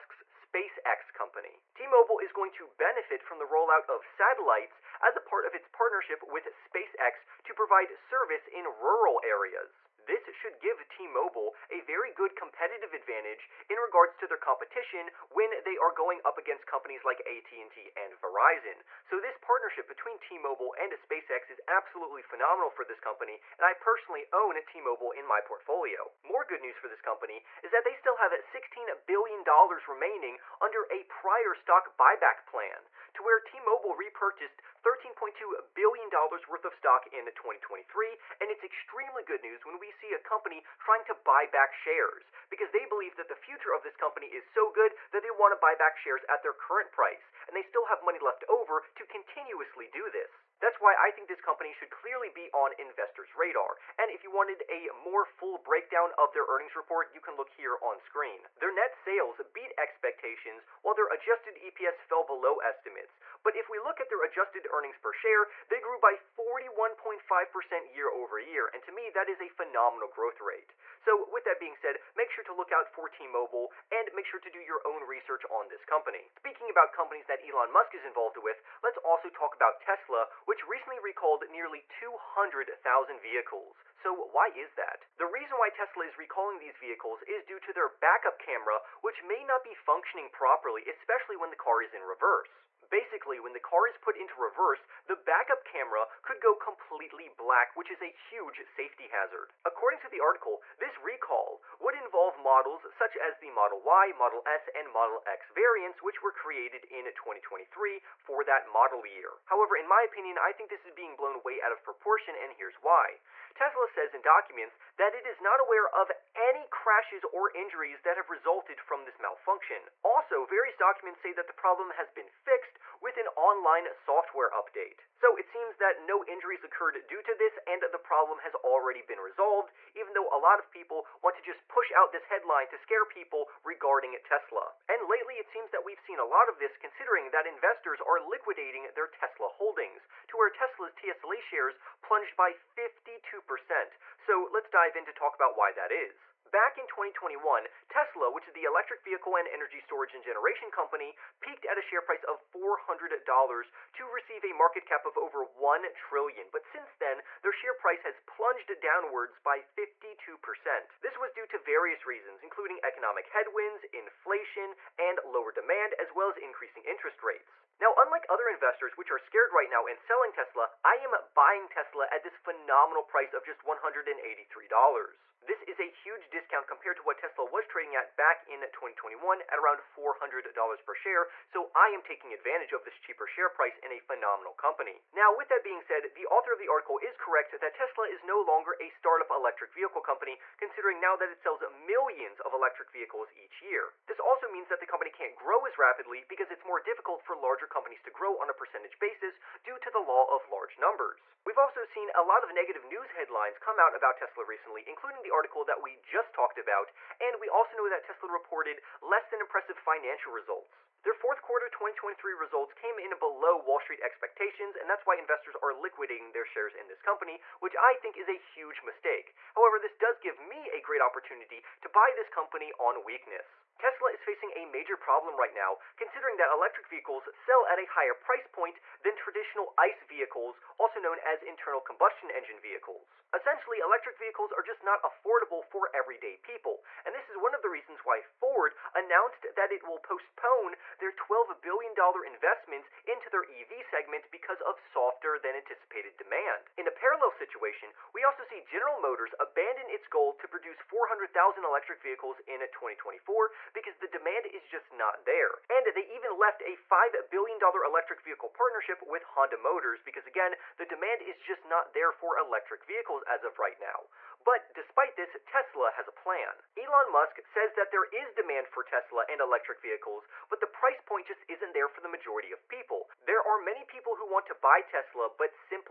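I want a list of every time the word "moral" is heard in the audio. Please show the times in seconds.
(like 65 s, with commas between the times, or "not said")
not said.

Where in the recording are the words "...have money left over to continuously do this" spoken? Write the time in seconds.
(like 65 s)
47 s.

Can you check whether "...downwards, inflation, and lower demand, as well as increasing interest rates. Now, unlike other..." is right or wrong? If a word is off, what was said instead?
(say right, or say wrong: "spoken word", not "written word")
wrong: "headwinds", not "downwards".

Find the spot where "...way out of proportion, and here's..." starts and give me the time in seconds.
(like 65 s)
111 s.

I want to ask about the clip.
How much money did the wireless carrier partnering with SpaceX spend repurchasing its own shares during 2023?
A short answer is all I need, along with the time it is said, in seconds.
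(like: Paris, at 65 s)
$13.2 billion, at 34 s.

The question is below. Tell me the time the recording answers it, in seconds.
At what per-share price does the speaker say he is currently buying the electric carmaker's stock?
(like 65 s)
173 s.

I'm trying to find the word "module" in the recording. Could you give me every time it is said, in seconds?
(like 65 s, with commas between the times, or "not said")
not said.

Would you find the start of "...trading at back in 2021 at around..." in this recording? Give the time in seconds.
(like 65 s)
177 s.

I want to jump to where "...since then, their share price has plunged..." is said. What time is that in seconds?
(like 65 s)
156 s.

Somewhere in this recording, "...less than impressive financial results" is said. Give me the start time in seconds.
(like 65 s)
209 s.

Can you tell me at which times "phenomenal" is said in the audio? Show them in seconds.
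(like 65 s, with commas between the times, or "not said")
22 s, 69 s, 172 s, 183 s.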